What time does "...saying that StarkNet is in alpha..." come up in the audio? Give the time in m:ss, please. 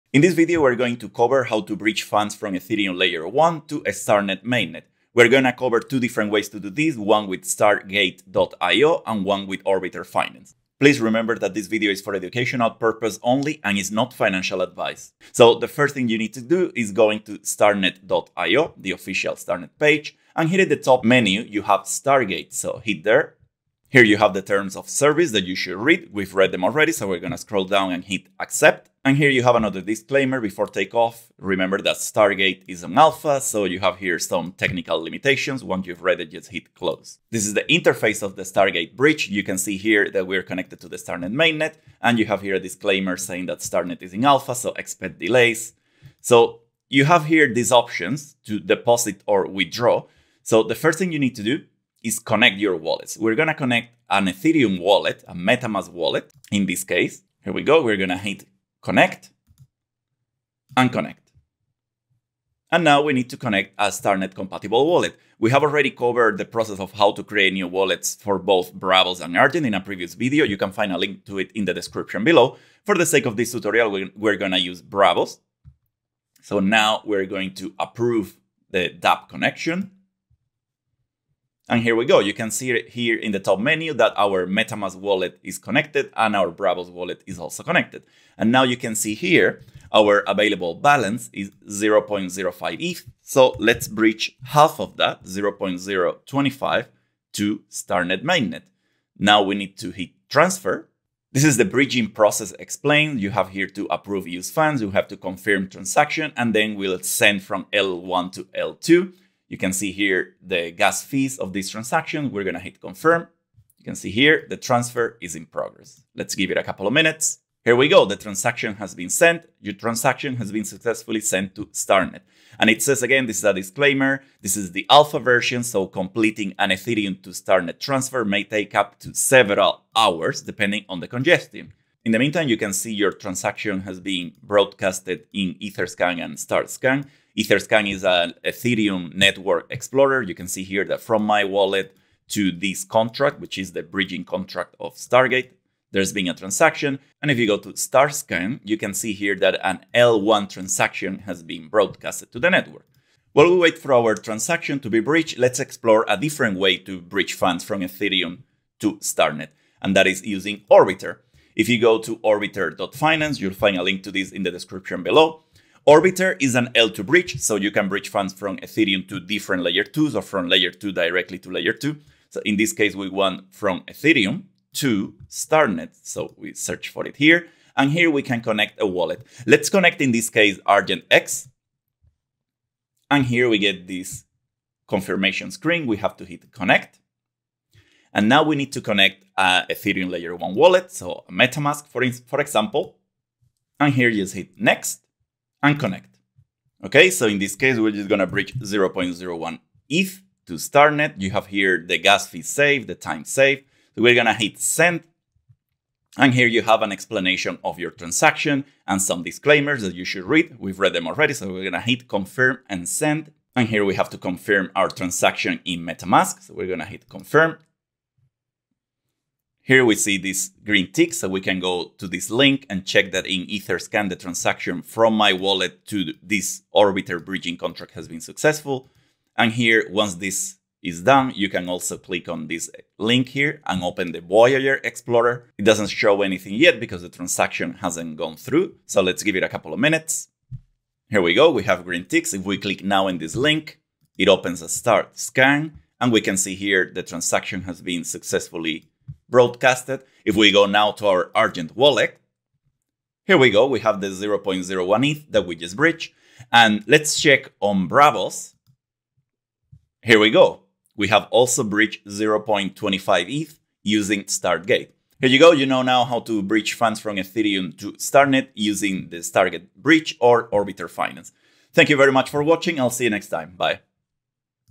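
0:43.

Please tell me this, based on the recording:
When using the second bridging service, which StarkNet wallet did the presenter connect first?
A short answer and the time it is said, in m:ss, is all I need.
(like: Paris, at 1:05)
Argent X, at 3:00.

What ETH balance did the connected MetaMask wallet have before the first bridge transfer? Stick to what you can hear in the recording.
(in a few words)
0.05 ETH.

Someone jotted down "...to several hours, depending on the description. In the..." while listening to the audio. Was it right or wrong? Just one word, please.
wrong.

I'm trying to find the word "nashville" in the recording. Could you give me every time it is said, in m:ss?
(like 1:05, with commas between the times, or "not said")
not said.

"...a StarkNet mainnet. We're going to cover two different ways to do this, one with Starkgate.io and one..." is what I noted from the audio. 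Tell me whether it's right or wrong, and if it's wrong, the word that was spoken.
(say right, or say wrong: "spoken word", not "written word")
right.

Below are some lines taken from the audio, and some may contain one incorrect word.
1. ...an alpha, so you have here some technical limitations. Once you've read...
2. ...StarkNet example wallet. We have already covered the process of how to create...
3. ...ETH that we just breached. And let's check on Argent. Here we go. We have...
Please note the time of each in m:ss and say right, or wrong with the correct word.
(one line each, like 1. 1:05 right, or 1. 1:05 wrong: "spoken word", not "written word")
1. 0:32 right
2. 1:03 wrong: "compatible", not "example"
3. 4:15 wrong: "Braavos", not "Argent".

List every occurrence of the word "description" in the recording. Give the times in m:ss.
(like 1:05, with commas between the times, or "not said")
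1:11, 2:44.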